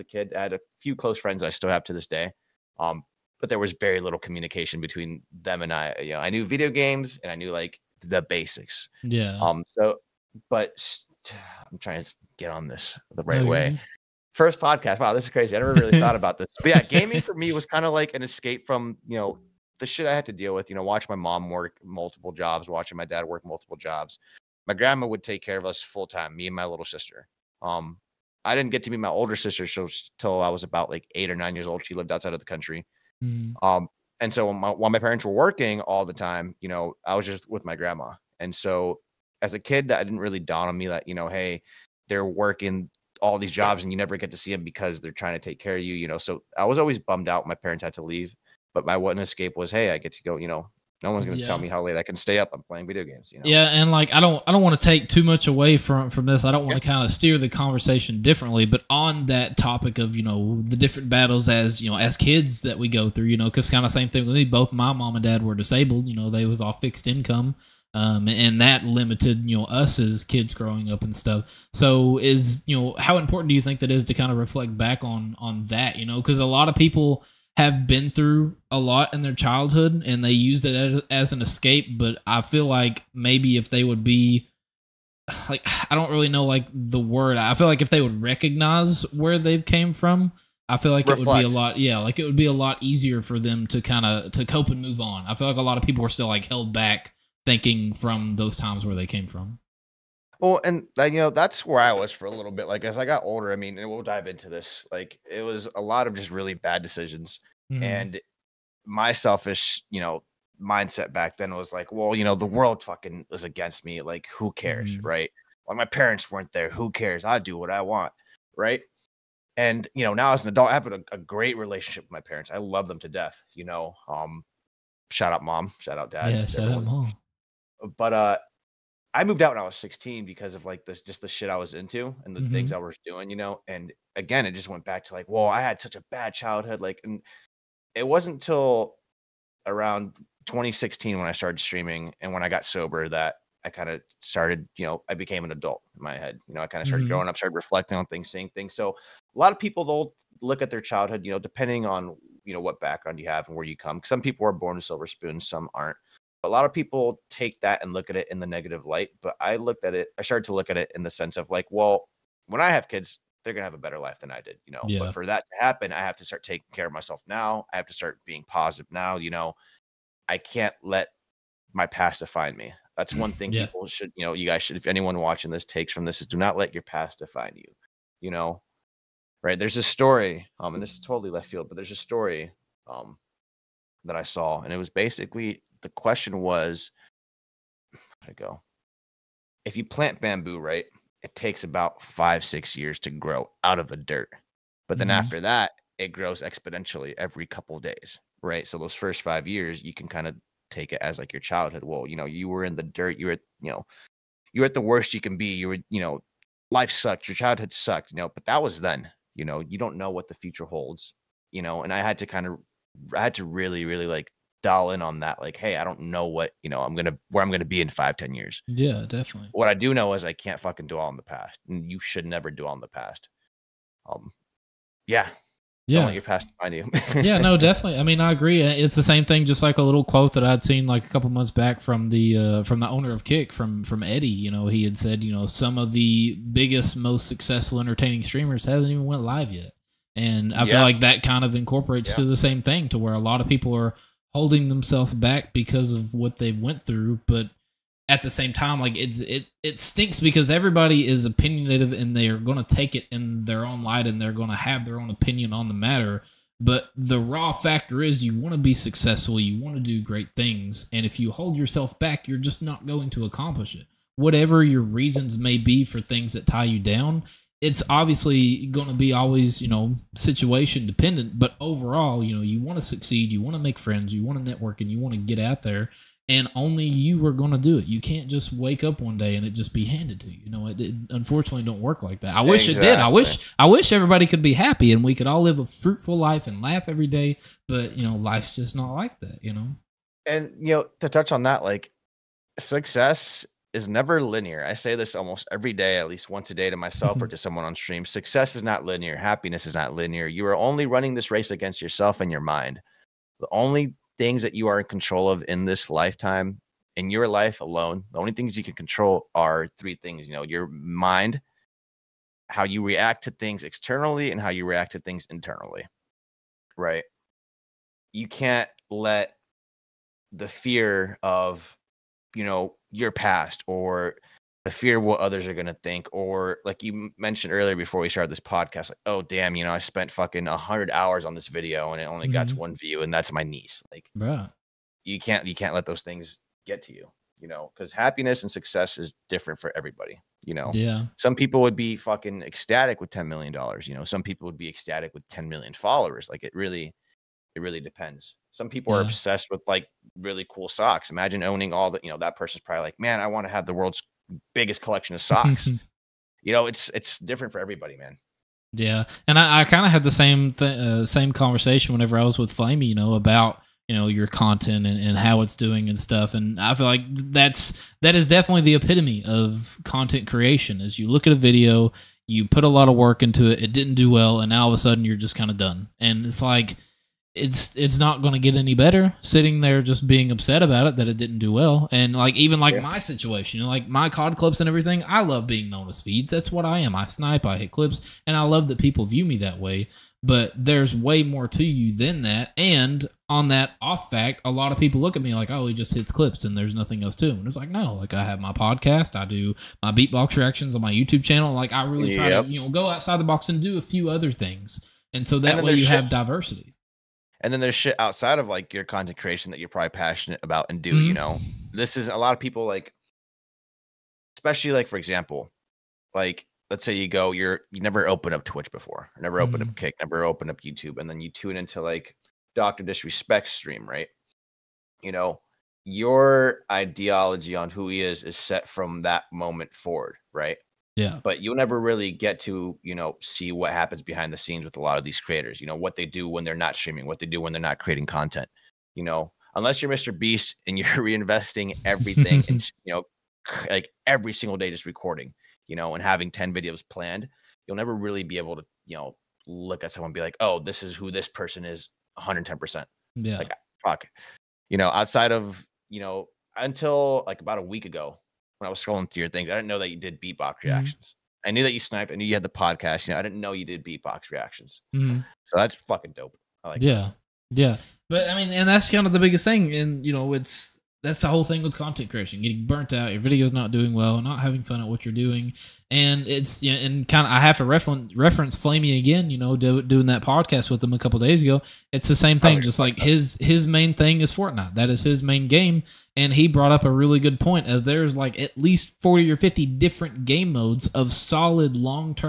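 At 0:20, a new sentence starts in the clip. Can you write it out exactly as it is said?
You know, watch my mom work multiple jobs, watching my dad work multiple jobs.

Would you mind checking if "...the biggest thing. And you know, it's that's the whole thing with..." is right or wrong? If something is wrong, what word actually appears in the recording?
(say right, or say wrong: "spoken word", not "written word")
right.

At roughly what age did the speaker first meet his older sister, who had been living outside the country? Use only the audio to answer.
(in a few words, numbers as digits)
8 or 9.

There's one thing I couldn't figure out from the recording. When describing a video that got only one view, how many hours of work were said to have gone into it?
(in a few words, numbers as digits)
100.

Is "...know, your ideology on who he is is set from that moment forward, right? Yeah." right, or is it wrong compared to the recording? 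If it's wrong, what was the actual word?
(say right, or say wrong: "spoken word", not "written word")
right.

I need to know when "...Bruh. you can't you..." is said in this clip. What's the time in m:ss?
5:34.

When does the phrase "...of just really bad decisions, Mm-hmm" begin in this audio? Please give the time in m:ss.
1:46.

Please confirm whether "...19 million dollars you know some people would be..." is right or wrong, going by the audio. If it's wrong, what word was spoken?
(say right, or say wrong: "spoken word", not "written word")
wrong: "10", not "19".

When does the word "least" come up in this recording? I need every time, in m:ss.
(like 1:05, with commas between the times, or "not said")
4:56, 8:08.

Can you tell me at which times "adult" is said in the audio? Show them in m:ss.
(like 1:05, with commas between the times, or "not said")
2:00, 2:25.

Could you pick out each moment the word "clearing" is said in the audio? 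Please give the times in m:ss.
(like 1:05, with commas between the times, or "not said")
not said.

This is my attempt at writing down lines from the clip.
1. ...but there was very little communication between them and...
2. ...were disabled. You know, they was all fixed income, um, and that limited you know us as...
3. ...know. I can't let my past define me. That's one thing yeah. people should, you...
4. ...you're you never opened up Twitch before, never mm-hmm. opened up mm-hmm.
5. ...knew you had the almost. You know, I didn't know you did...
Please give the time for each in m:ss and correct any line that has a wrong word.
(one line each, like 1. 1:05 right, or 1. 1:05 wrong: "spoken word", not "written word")
1. 0:03 right
2. 1:05 right
3. 2:49 right
4. 6:57 right
5. 7:42 wrong: "podcast", not "almost".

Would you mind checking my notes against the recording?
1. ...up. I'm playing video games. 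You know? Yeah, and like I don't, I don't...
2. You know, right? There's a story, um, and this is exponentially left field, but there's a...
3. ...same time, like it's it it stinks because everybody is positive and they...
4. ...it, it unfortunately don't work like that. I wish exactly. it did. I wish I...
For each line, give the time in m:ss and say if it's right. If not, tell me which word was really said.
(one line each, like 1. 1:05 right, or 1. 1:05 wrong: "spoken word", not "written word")
1. 0:52 right
2. 2:58 wrong: "totally", not "exponentially"
3. 4:08 wrong: "opinionative", not "positive"
4. 4:40 right.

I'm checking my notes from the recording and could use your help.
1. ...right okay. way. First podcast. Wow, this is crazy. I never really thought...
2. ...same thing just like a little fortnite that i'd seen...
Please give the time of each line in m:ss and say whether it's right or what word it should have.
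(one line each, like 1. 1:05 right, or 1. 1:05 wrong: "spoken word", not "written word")
1. 0:13 right
2. 3:49 wrong: "quote", not "fortnite".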